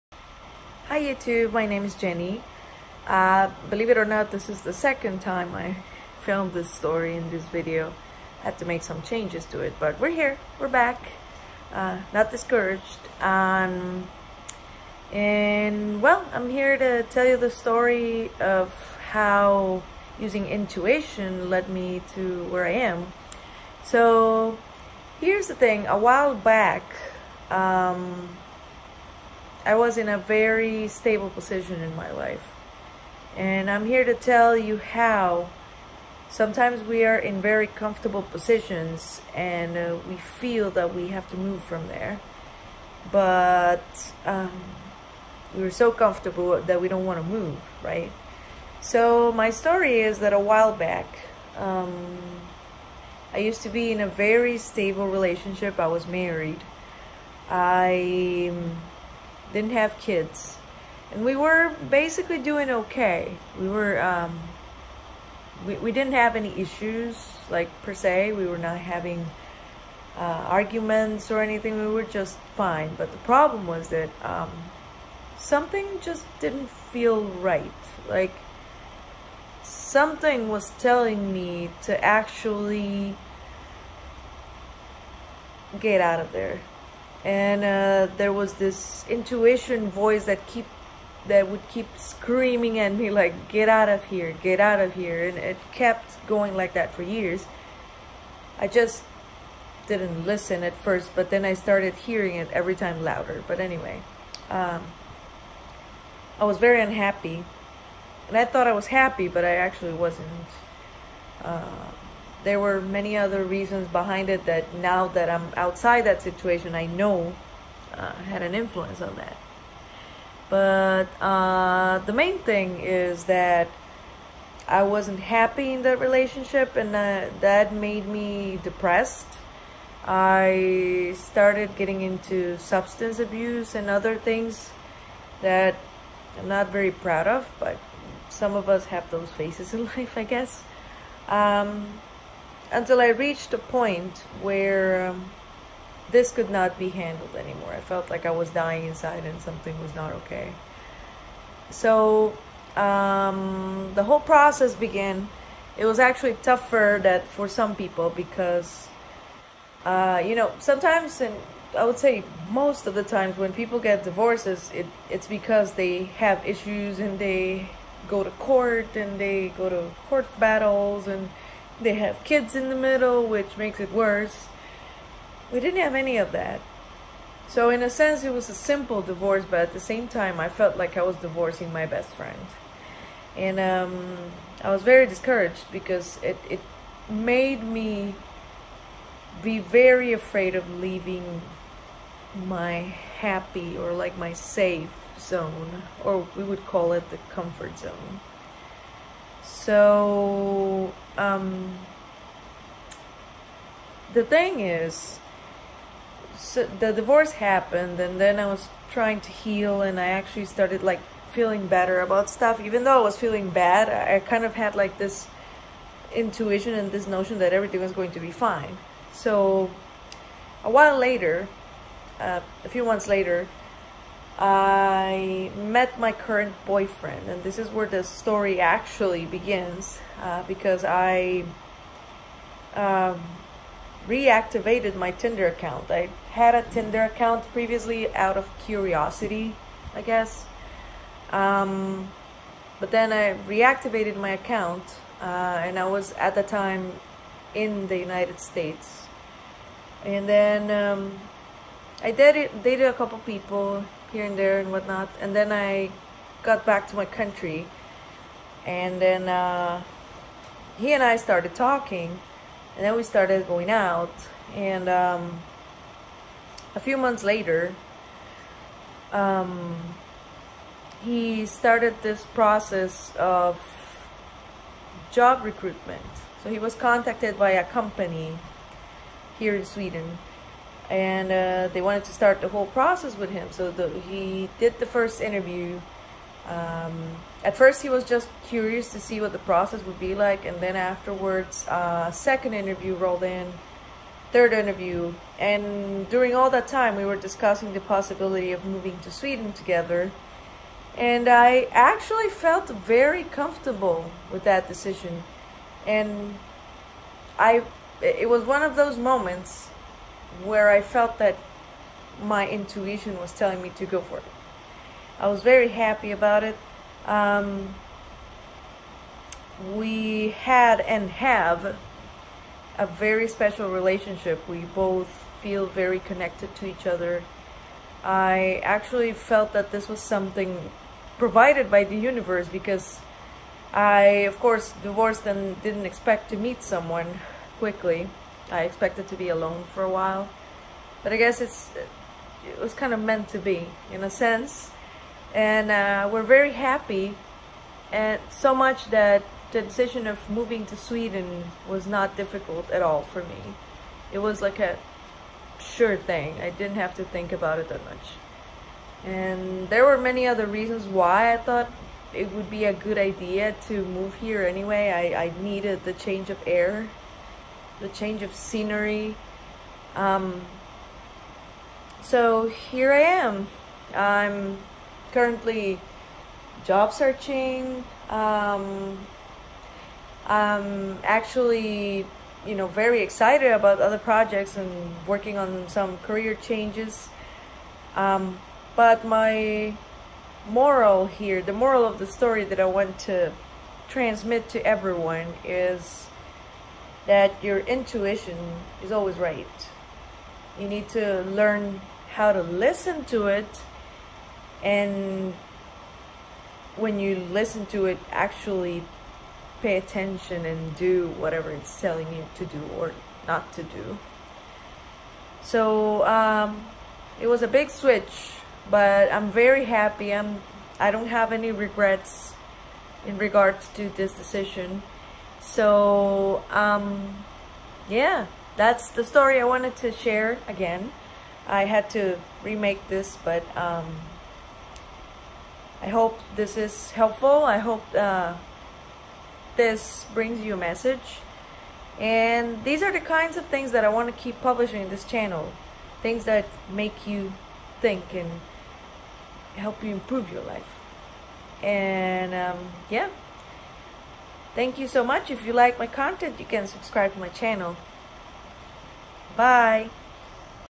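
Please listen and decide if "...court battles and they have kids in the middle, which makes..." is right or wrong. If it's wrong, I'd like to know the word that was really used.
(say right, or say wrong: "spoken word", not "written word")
right.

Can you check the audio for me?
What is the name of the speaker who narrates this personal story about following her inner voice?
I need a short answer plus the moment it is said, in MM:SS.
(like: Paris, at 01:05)
Jenny, at 00:01.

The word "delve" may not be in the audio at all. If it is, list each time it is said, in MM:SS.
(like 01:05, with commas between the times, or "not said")
not said.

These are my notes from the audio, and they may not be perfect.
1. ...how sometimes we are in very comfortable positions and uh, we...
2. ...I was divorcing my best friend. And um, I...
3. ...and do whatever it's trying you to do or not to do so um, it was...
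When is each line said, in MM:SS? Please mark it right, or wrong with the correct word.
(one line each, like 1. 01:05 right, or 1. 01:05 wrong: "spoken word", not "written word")
1. 00:34 right
2. 03:00 right
3. 06:50 wrong: "telling", not "trying".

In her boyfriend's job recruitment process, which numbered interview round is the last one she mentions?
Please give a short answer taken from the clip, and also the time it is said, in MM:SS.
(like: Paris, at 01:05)
Third, at 04:54.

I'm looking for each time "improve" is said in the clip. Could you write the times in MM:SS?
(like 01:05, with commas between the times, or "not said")
07:29.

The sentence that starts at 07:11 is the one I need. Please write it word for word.
I had to remake this, but um, I hope this is helpful.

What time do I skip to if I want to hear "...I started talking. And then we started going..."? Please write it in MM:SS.
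04:21.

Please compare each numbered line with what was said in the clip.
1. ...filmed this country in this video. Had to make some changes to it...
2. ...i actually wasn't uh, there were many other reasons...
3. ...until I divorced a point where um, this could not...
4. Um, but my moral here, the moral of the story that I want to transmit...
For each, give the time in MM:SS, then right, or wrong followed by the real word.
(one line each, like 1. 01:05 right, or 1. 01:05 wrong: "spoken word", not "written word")
1. 00:06 wrong: "story", not "country"
2. 01:49 right
3. 02:22 wrong: "reached", not "divorced"
4. 06:27 right.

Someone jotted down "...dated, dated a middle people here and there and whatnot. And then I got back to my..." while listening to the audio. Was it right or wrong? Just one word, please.
wrong.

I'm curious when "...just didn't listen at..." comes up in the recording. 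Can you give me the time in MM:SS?
01:38.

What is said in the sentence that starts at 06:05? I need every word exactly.
I, I needed the change of air the change of scenery.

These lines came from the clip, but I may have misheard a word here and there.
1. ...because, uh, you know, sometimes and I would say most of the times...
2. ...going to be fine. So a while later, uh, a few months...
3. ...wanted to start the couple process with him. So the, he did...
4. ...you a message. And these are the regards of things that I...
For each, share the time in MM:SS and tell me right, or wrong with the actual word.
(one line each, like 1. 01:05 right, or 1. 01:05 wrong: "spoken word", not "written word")
1. 02:38 right
2. 03:37 right
3. 04:41 wrong: "whole", not "couple"
4. 07:20 wrong: "kinds", not "regards".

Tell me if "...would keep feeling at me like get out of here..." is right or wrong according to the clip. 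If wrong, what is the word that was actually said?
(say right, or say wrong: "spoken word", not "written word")
wrong: "screaming", not "feeling".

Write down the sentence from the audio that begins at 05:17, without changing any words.
Um, we had and have a very special relationship.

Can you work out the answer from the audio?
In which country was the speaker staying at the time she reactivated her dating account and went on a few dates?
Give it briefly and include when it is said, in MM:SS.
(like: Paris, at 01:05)
United States, at 04:07.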